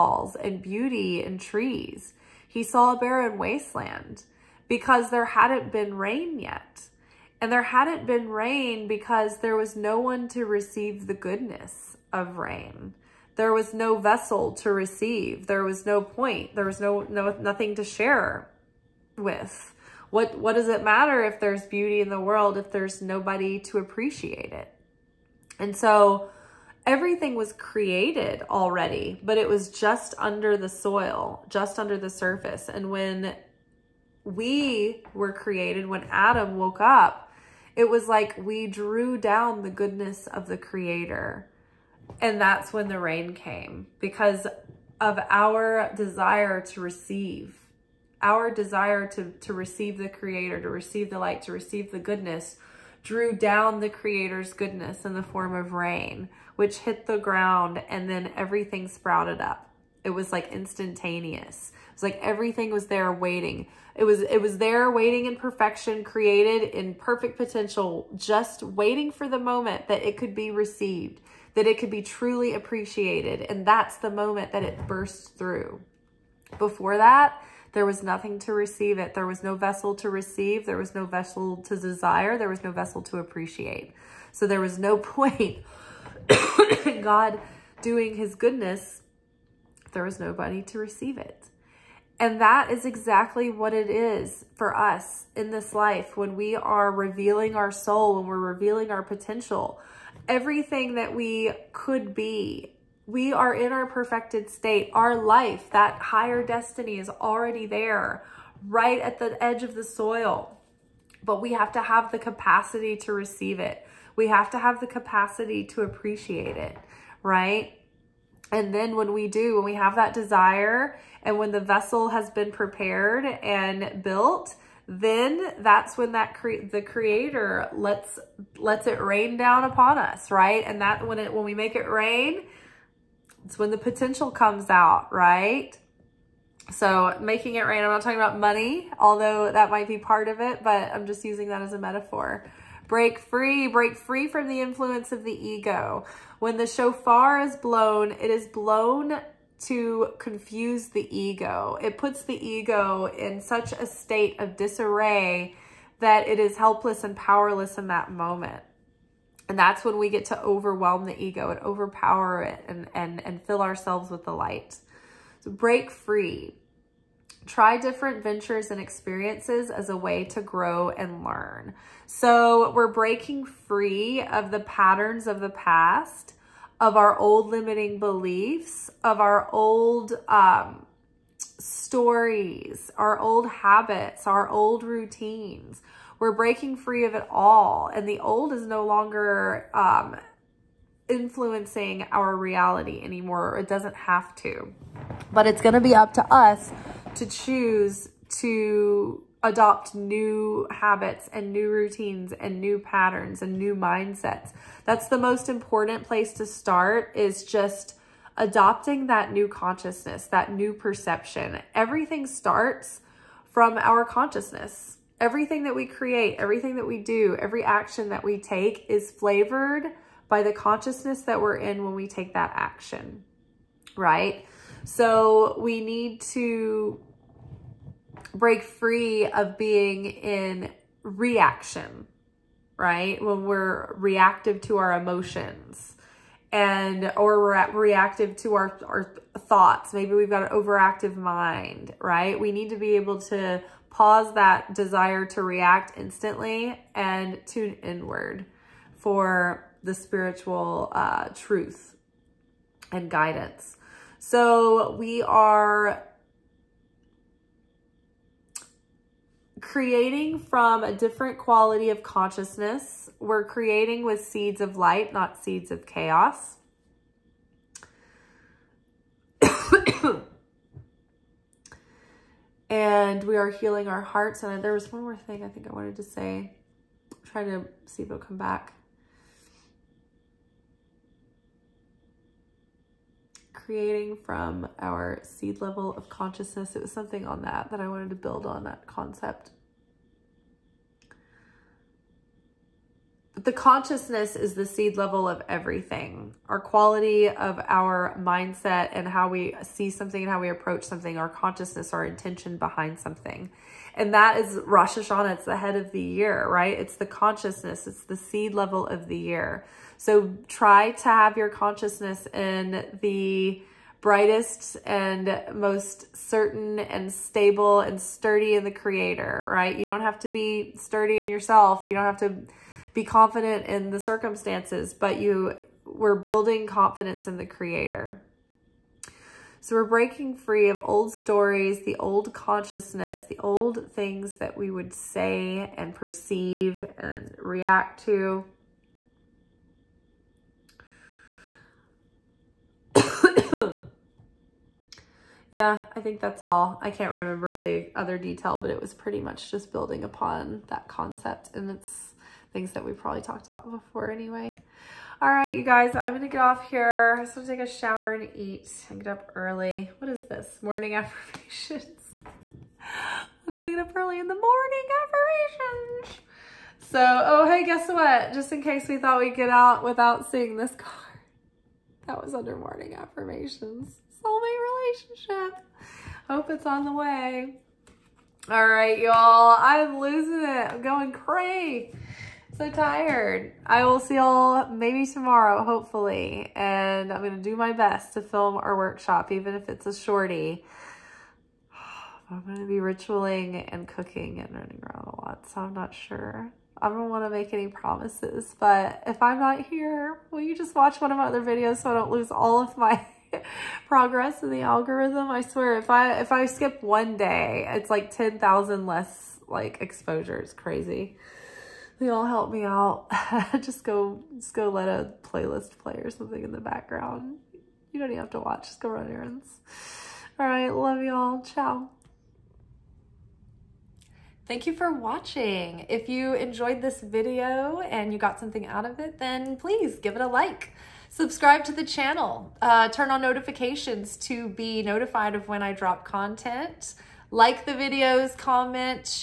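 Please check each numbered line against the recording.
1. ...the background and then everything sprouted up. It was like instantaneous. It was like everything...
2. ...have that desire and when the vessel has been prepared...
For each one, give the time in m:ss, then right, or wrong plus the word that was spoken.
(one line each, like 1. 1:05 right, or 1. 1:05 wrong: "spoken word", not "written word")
1. 0:57 wrong: "ground", not "background"
2. 1:59 right.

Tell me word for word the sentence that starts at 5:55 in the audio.
All right, you guys, I'm gonna get off here.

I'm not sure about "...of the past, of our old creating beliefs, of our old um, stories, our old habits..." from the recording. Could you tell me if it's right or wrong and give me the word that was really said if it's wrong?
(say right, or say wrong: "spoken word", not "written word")
wrong: "limiting", not "creating".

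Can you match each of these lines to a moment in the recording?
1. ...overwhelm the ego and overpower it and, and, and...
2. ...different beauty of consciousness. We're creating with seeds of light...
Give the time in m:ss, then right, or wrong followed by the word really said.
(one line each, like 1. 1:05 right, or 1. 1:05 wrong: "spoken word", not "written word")
1. 2:40 right
2. 4:20 wrong: "quality", not "beauty".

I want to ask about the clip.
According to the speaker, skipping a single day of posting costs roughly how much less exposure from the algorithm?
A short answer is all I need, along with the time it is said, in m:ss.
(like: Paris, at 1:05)
10,000, at 6:48.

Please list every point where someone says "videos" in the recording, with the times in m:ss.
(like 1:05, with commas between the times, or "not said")
6:41, 7:07, 7:17.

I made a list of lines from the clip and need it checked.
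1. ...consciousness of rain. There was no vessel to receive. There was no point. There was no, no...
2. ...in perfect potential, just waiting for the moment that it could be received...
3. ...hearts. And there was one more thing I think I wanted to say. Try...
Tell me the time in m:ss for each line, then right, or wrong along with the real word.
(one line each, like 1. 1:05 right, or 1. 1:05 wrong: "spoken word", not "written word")
1. 0:11 wrong: "goodness", not "consciousness"
2. 1:06 right
3. 4:34 right.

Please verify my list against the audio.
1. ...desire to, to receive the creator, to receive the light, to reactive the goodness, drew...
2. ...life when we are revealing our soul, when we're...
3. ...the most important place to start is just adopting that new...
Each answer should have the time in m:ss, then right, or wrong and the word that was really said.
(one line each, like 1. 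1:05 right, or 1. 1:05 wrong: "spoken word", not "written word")
1. 0:48 wrong: "receive", not "reactive"
2. 1:35 right
3. 3:25 right.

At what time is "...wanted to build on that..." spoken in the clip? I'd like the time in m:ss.
4:47.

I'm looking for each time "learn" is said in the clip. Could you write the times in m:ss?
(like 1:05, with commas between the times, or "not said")
2:51.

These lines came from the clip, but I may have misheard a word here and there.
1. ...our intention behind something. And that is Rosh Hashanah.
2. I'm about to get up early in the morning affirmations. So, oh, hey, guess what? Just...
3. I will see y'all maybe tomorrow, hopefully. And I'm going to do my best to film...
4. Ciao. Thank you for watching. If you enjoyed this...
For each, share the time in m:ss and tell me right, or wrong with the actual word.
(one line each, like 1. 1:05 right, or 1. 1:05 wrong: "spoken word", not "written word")
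1. 5:01 right
2. 6:02 right
3. 6:23 right
4. 7:01 right.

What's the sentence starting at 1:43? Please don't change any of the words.
We are in our perfected state.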